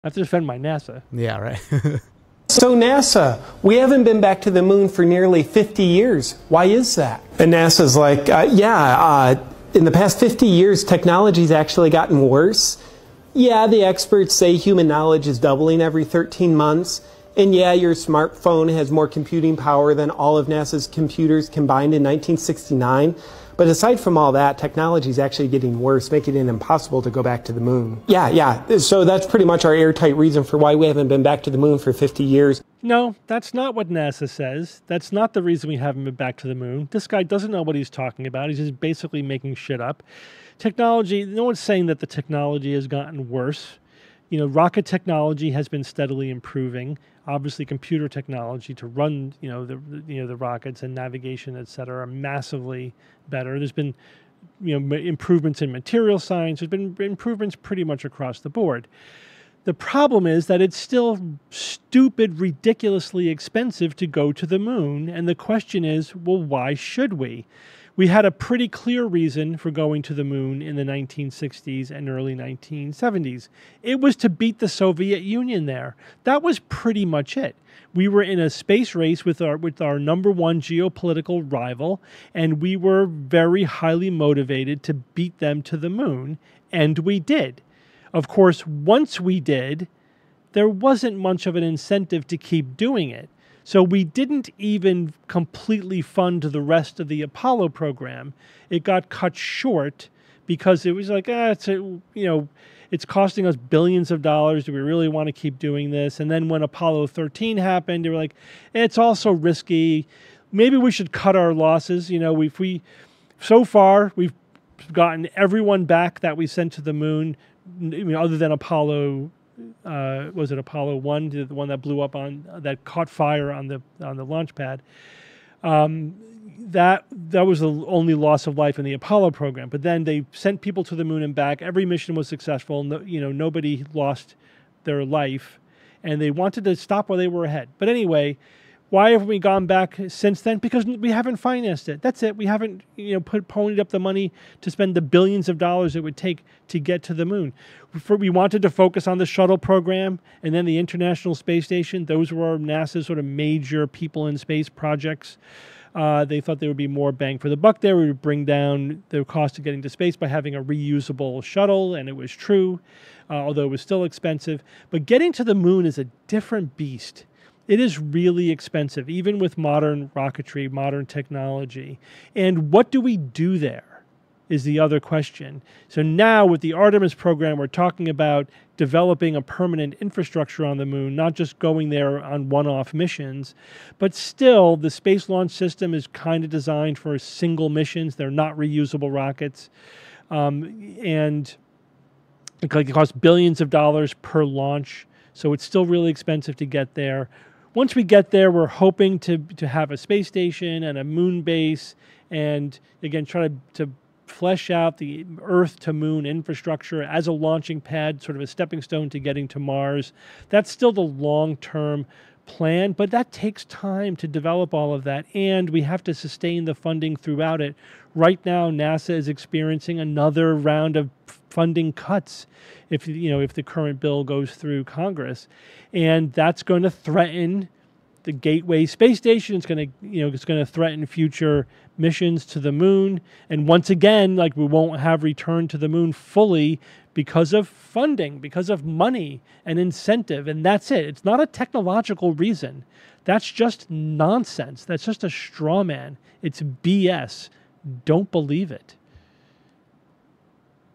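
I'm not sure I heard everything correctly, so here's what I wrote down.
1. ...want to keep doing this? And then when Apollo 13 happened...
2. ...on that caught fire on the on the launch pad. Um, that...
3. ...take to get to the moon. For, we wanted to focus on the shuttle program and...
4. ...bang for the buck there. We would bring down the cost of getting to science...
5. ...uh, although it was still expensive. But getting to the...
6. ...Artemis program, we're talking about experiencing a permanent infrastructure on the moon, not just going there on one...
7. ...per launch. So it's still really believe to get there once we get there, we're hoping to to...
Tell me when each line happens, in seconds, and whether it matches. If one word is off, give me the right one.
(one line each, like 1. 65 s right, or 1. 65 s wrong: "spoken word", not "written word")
1. 105 s right
2. 122 s right
3. 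146 s right
4. 157 s wrong: "space", not "science"
5. 163 s right
6. 176 s wrong: "developing", not "experiencing"
7. 194 s wrong: "expensive", not "believe".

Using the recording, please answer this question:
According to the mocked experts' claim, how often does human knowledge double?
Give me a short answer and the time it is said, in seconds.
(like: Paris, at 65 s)
every 13 months, at 15 s.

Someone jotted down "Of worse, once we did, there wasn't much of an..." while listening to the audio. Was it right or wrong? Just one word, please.
wrong.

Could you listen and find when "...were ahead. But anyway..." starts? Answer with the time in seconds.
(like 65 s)
137 s.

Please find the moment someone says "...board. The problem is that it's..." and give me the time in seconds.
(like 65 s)
58 s.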